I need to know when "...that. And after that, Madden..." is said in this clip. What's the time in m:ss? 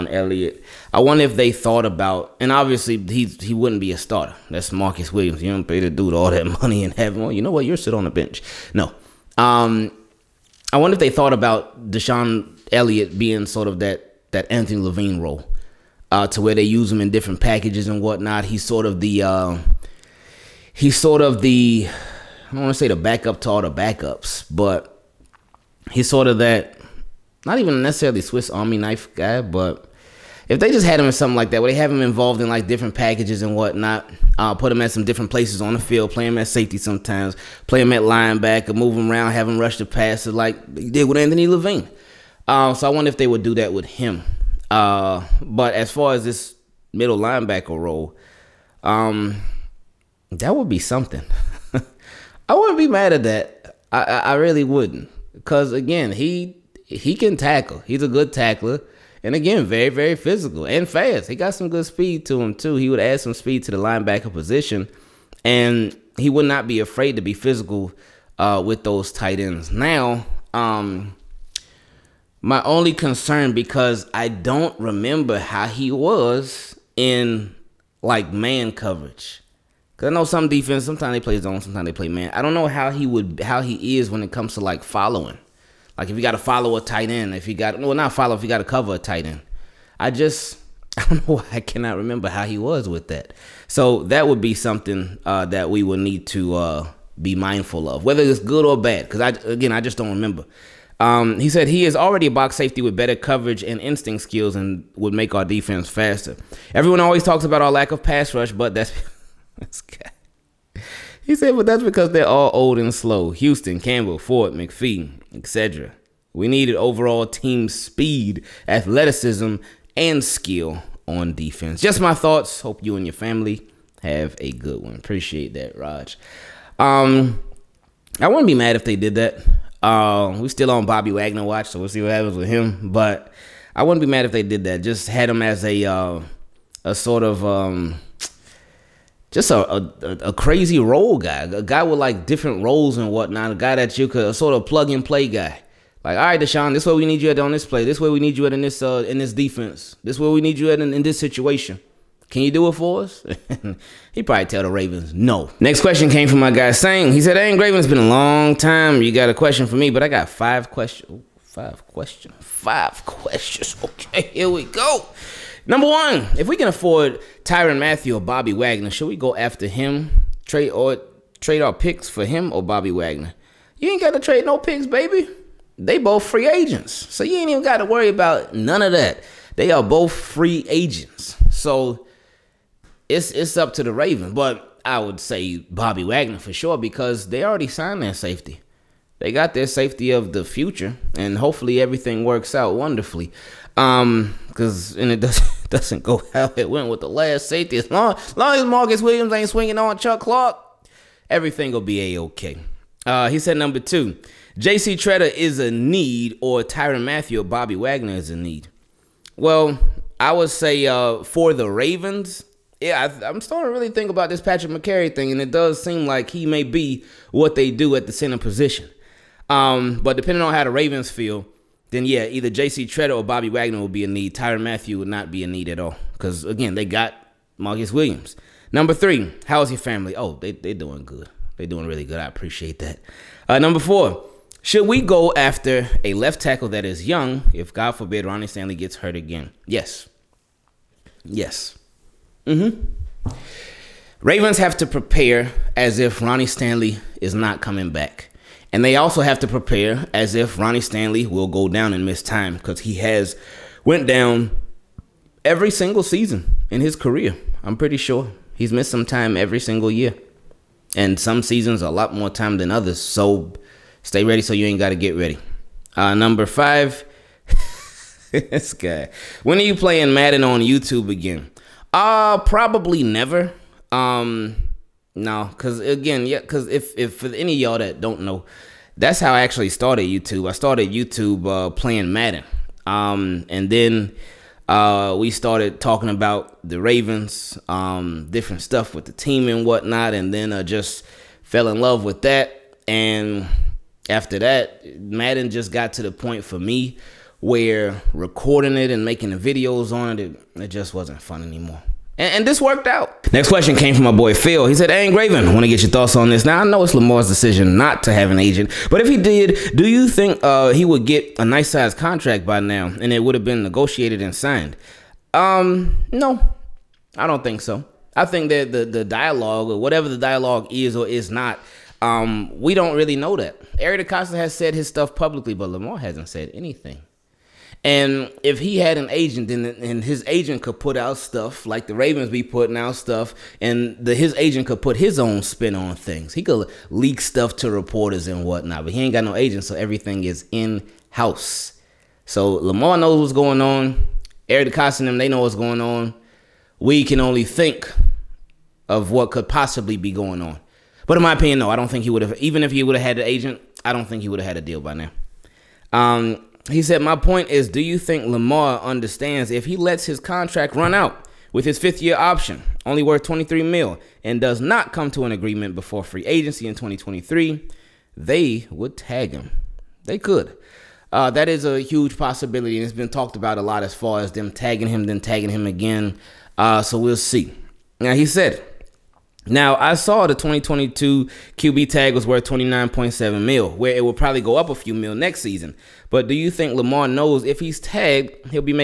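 4:52.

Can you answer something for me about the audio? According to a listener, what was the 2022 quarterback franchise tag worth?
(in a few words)
29.7 million.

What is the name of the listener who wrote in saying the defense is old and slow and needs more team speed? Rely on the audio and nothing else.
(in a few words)
Raj.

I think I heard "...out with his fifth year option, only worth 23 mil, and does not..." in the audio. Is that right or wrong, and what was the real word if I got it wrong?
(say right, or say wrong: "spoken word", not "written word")
right.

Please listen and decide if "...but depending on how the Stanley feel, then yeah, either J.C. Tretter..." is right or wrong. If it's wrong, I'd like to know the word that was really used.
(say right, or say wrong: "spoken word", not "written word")
wrong: "Ravens", not "Stanley".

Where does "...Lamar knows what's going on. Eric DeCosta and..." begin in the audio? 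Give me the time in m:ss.
5:42.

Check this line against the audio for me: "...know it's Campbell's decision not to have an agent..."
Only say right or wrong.
wrong.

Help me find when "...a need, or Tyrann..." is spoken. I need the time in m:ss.
3:25.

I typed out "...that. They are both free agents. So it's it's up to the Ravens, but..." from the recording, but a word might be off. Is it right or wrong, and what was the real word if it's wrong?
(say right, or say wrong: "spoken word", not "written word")
right.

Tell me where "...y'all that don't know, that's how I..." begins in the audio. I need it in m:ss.
4:37.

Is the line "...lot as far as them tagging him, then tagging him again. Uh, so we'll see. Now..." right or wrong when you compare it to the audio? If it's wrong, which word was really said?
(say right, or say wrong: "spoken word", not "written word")
right.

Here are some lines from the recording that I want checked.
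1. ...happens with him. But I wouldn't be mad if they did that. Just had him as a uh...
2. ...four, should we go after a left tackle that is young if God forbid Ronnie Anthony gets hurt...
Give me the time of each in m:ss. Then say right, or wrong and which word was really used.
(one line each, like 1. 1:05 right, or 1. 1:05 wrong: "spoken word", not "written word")
1. 2:12 right
2. 3:53 wrong: "Stanley", not "Anthony".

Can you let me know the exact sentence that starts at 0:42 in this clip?
Uh, so I wonder if they would do that with him.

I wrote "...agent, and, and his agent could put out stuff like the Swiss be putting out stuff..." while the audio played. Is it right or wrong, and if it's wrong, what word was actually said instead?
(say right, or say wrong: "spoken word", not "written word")
wrong: "Ravens", not "Swiss".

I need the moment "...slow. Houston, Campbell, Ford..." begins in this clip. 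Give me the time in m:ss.
1:52.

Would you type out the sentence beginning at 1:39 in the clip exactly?
Because I again, I just don't remember.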